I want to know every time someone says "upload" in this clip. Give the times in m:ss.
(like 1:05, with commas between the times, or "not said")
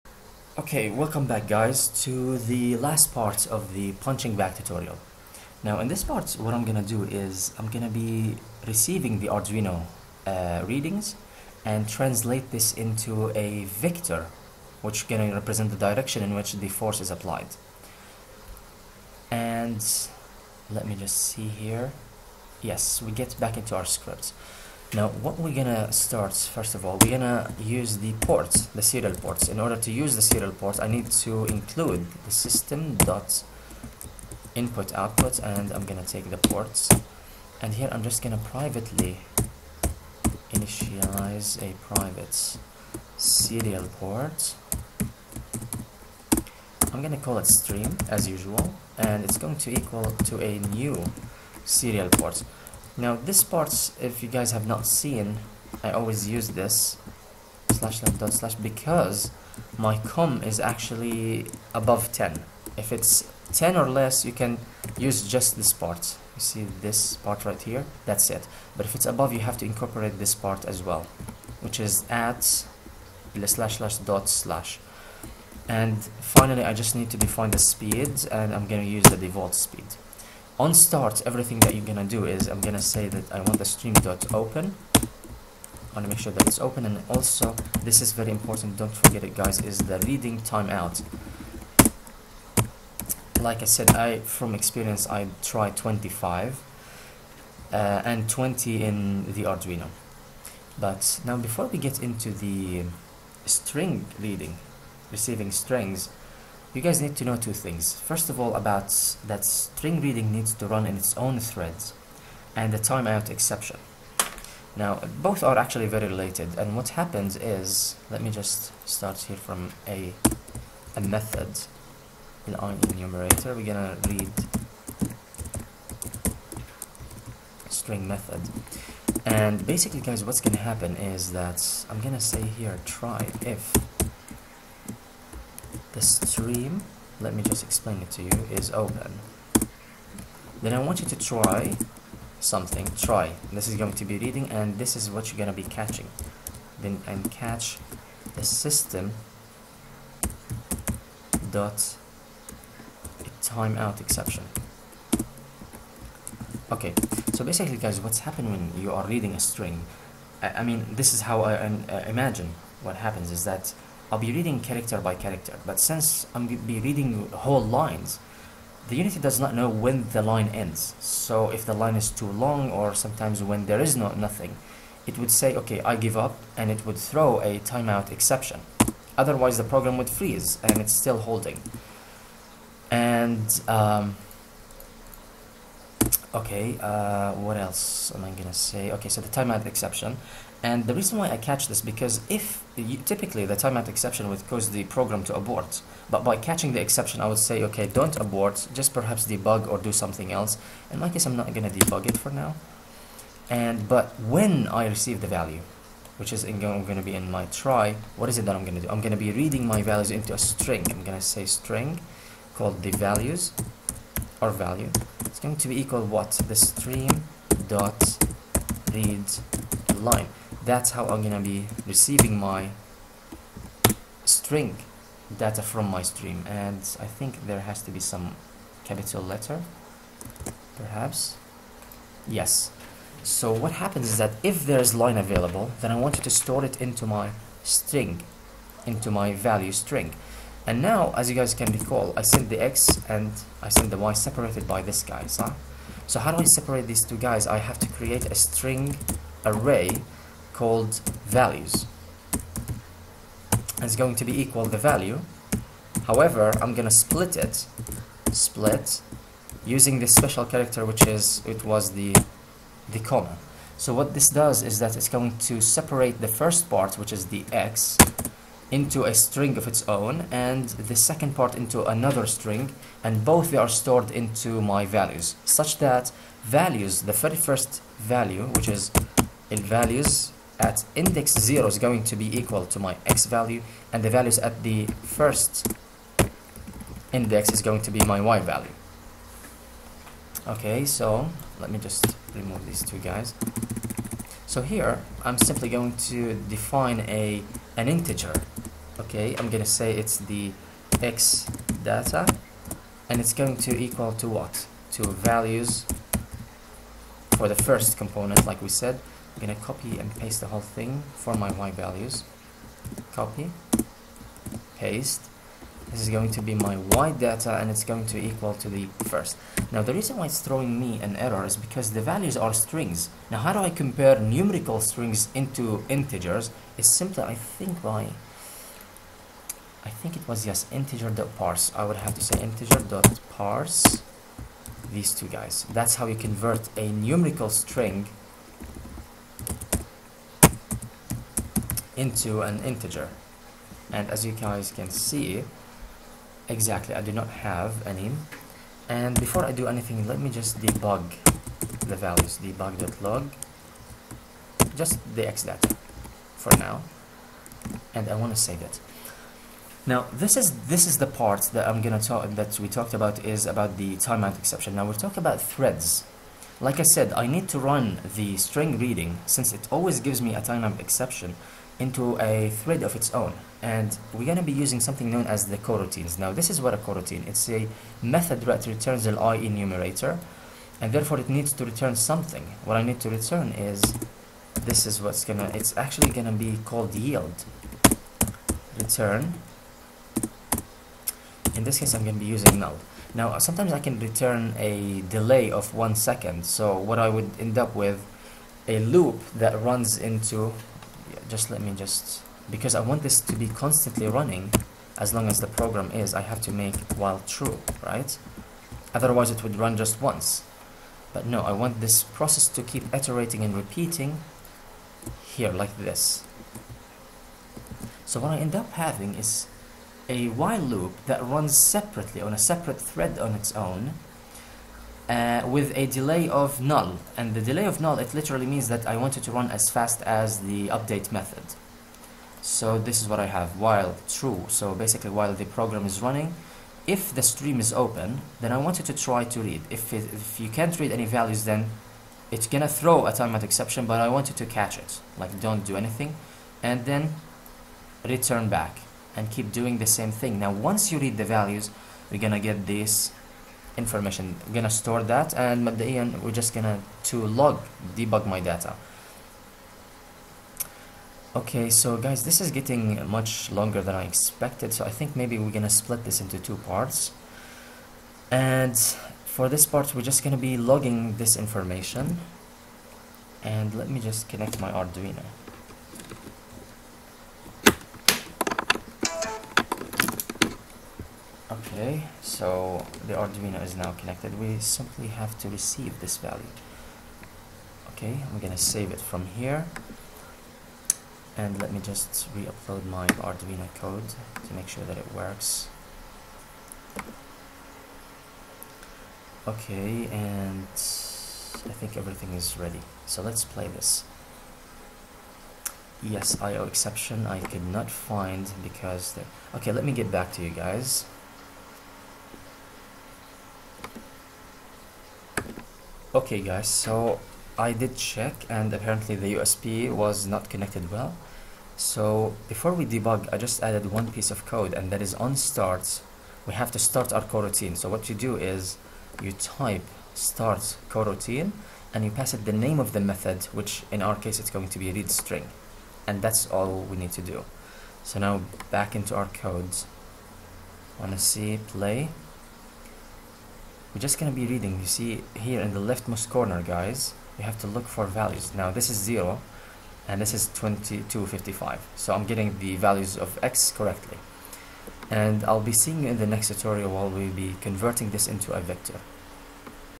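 8:12.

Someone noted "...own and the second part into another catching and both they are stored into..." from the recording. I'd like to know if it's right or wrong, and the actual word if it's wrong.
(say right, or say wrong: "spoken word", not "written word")
wrong: "string", not "catching".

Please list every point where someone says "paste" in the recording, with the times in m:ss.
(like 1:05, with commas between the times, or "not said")
5:10, 5:14.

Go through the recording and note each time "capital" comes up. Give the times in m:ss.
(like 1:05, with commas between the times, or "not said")
3:48.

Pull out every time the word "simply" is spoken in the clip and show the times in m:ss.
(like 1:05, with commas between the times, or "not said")
4:55, 5:26, 8:04.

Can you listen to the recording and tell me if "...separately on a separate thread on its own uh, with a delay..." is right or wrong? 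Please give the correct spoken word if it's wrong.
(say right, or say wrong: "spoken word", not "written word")
right.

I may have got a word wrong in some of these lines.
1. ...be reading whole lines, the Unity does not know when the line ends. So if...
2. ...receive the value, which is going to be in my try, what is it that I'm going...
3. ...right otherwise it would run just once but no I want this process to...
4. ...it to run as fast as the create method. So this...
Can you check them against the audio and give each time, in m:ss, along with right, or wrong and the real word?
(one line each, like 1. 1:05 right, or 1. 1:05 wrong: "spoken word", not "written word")
1. 2:46 right
2. 3:24 right
3. 6:47 right
4. 7:09 wrong: "update", not "create".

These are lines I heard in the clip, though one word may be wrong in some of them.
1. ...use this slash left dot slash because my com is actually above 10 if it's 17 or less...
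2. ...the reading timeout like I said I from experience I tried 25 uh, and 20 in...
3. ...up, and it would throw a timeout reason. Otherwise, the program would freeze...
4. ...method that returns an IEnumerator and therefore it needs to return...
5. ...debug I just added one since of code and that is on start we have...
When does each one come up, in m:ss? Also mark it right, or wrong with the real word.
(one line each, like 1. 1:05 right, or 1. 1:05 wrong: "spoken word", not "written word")
1. 0:56 wrong: "10", not "17"
2. 1:29 right
3. 2:56 wrong: "exception", not "reason"
4. 6:18 right
5. 8:42 wrong: "piece", not "since".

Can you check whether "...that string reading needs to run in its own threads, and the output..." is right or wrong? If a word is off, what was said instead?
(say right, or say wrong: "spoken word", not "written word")
wrong: "timeout", not "output".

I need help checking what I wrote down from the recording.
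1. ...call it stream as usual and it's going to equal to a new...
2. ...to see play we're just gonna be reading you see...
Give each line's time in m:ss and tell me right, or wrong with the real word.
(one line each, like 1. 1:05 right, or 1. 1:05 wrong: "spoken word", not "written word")
1. 0:47 right
2. 9:01 right.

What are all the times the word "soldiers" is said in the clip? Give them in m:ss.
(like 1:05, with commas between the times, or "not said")
not said.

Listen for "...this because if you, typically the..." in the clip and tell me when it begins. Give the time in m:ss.
3:11.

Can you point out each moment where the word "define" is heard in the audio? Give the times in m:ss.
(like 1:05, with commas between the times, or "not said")
1:17, 4:56.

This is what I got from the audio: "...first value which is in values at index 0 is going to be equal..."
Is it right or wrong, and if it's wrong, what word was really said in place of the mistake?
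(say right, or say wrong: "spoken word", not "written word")
right.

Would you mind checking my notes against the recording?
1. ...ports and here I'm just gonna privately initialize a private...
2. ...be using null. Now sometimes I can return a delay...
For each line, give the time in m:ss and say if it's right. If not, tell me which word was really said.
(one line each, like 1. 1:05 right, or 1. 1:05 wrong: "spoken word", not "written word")
1. 0:36 right
2. 6:32 right.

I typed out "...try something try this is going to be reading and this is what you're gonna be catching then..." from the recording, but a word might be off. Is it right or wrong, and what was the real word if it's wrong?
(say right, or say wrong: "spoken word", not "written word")
right.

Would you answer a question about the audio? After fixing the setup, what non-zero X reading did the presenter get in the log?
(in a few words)
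2255.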